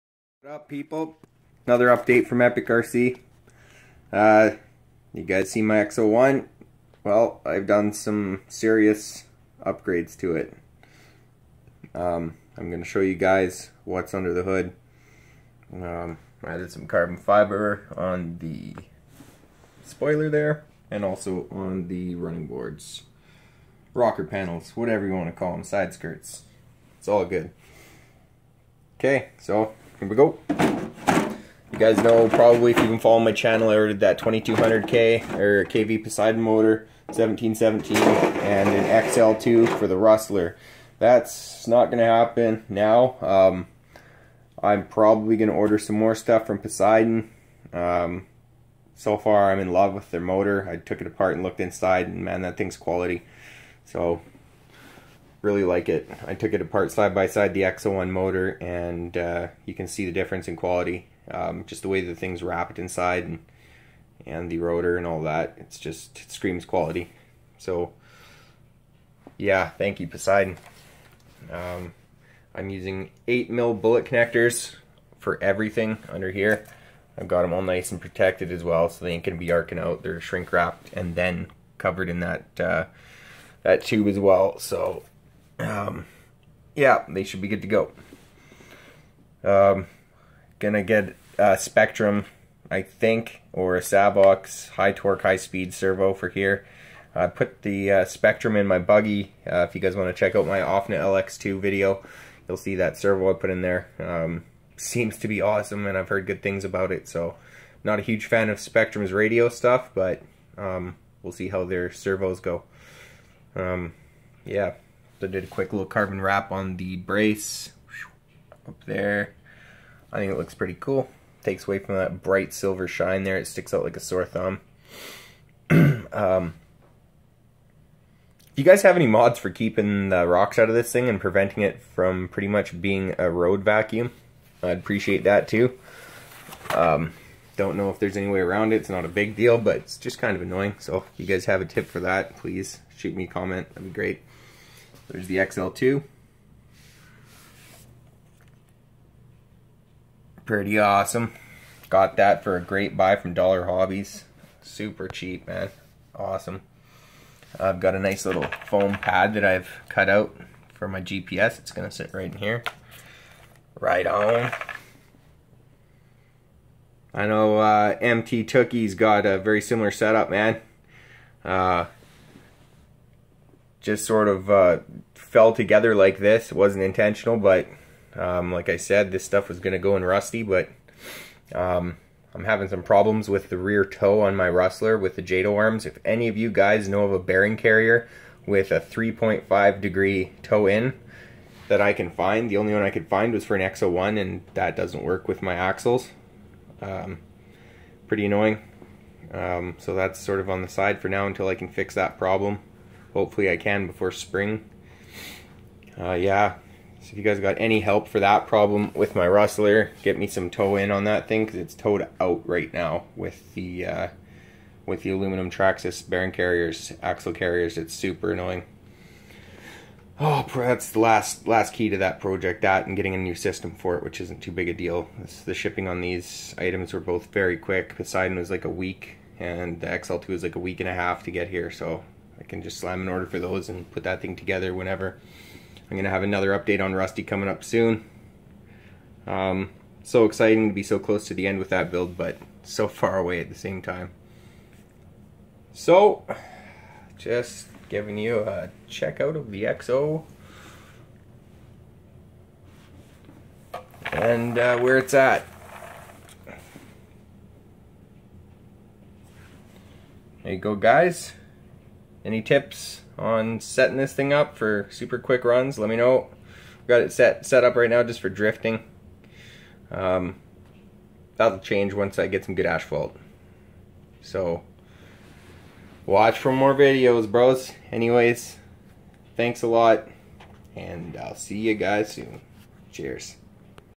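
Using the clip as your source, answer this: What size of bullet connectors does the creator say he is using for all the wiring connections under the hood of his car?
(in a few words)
8 mil.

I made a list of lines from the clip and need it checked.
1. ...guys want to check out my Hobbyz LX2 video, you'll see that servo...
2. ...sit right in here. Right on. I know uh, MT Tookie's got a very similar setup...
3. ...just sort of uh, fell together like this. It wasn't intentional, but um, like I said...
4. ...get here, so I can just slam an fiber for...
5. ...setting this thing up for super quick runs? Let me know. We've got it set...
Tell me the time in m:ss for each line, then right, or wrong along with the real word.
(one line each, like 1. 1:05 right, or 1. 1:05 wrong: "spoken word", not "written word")
1. 1:39 wrong: "OFNA", not "Hobbyz"
2. 2:41 right
3. 2:53 right
4. 3:51 wrong: "order", not "fiber"
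5. 4:23 right.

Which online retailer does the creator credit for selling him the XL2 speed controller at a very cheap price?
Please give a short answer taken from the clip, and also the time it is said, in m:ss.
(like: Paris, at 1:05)
Dollar Hobbyz, at 2:33.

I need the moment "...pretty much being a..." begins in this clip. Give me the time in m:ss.
2:12.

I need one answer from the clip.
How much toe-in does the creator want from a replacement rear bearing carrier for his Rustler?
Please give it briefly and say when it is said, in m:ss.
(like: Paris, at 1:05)
3.5 degree, at 3:08.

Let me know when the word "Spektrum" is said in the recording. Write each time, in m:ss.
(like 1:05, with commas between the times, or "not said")
1:31, 1:38, 1:48.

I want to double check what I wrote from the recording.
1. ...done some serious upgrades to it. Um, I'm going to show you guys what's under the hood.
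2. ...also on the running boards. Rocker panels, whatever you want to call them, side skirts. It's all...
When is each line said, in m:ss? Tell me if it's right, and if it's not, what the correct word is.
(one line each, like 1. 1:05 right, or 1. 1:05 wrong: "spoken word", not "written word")
1. 0:07 right
2. 0:21 right.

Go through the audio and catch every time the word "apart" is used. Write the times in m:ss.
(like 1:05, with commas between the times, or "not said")
0:51, 0:56.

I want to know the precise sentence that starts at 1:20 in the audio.
They're shrink wrapped and then covered in that uh, that tube as well.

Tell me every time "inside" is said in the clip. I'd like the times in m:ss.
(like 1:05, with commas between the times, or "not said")
0:51, 1:02.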